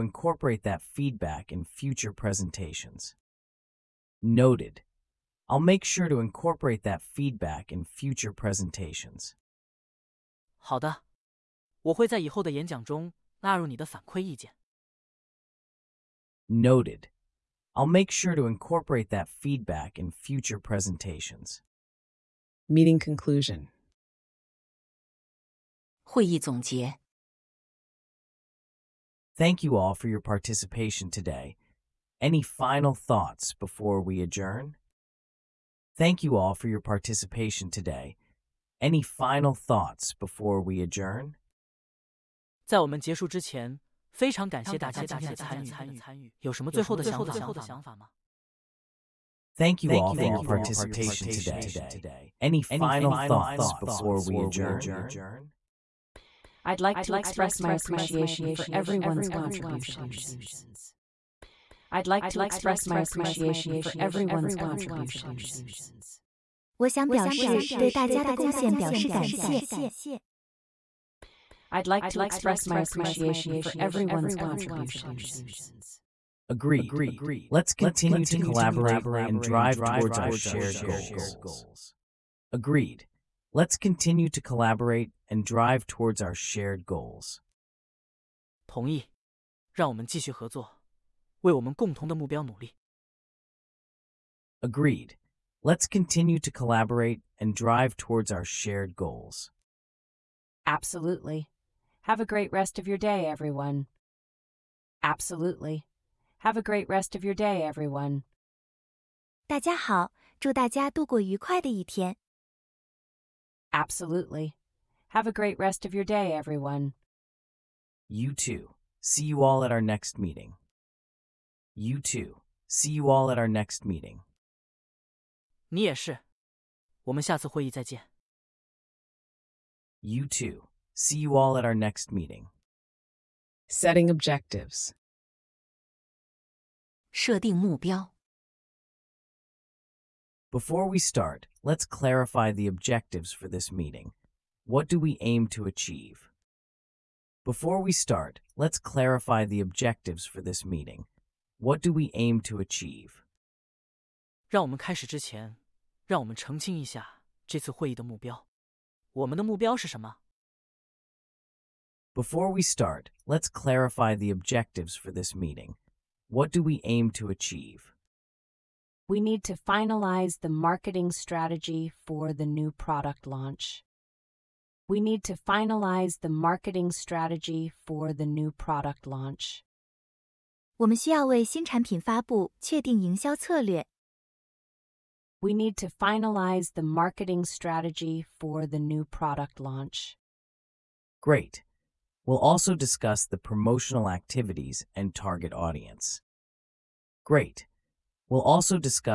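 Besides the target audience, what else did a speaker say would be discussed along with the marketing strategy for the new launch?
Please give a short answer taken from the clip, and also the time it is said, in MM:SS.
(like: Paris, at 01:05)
Promotional activities, at 03:13.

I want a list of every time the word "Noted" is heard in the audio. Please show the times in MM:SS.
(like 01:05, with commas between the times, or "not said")
00:04, 00:16.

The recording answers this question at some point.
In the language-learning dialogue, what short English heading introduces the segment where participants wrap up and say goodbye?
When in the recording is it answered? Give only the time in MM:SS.
00:22.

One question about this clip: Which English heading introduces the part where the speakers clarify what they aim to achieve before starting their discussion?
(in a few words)
Setting objectives.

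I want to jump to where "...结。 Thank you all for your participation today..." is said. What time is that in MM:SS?
00:26.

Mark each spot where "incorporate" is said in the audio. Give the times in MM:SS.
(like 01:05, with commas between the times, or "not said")
00:06, 00:18.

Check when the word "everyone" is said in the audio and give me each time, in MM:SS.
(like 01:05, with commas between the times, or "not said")
00:58, 01:03, 01:13, 01:43, 01:47, 01:56.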